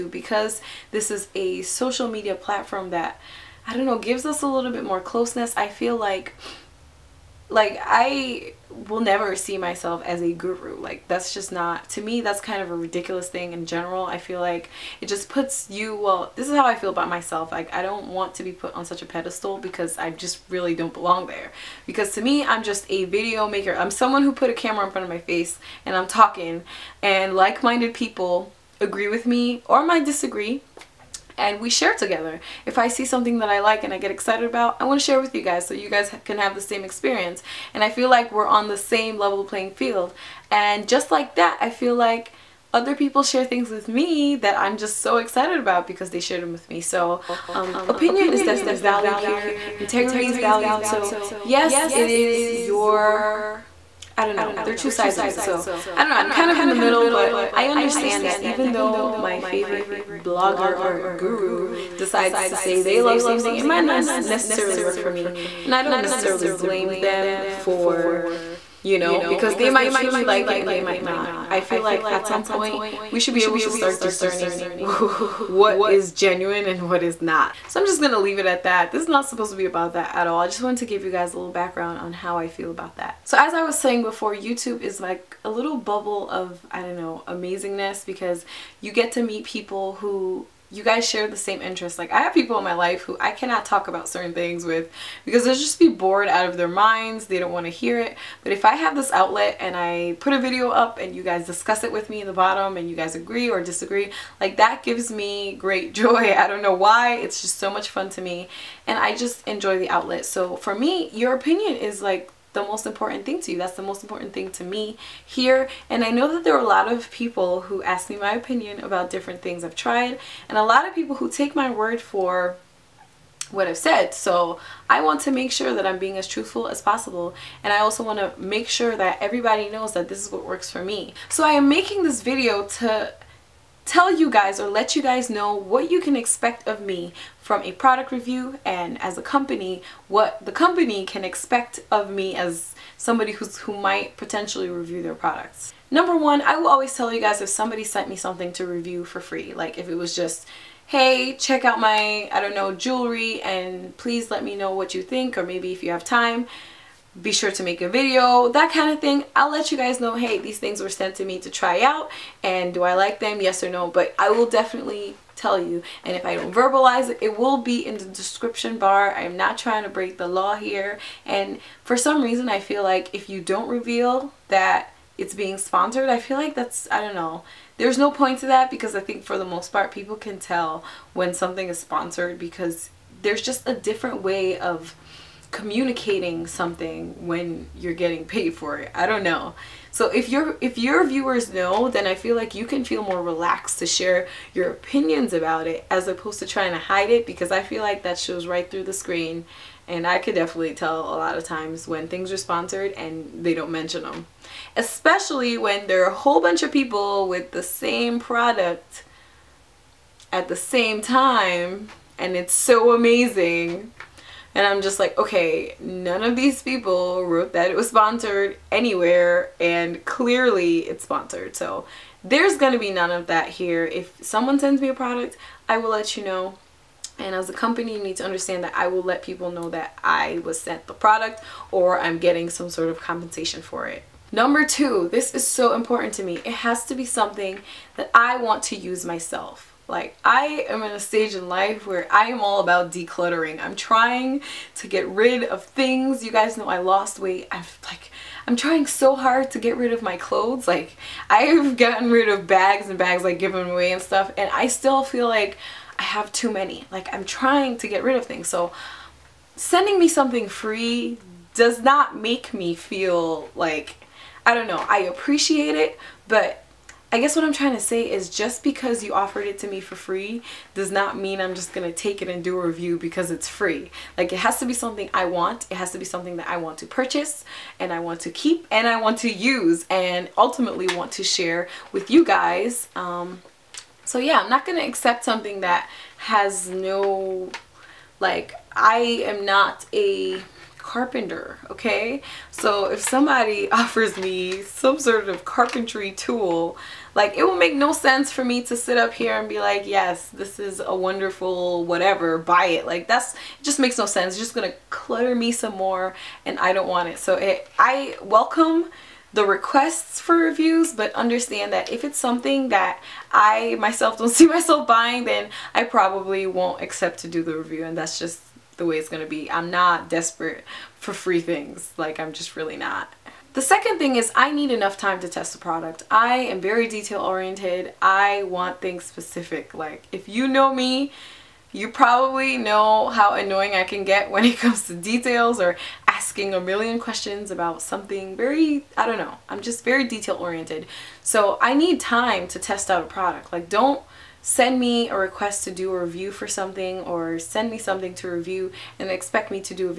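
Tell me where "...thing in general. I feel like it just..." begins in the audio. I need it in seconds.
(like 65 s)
13 s.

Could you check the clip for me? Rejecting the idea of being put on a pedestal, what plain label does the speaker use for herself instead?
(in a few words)
video maker.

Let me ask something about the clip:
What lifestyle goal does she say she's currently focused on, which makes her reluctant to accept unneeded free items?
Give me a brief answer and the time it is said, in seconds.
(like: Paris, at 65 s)
decluttering, at 242 s.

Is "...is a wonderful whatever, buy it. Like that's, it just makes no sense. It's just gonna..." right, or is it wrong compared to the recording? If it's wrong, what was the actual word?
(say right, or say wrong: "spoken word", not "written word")
right.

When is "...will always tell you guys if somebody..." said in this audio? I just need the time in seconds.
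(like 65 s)
146 s.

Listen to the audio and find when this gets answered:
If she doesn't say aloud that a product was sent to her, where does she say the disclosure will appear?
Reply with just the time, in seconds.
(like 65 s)
168 s.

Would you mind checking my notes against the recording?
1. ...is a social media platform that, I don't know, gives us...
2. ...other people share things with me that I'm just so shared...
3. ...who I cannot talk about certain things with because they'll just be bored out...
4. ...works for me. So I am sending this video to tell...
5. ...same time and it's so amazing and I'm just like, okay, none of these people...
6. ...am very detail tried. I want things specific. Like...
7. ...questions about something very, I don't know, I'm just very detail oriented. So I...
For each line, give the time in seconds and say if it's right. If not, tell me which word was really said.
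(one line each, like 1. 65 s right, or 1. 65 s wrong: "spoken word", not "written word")
1. 1 s right
2. 42 s wrong: "excited", not "shared"
3. 93 s right
4. 130 s wrong: "making", not "sending"
5. 210 s right
6. 326 s wrong: "oriented", not "tried"
7. 336 s right.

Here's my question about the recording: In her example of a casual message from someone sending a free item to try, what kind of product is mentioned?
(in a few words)
jewelry.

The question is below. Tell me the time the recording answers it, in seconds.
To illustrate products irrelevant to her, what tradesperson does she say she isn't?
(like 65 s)
290 s.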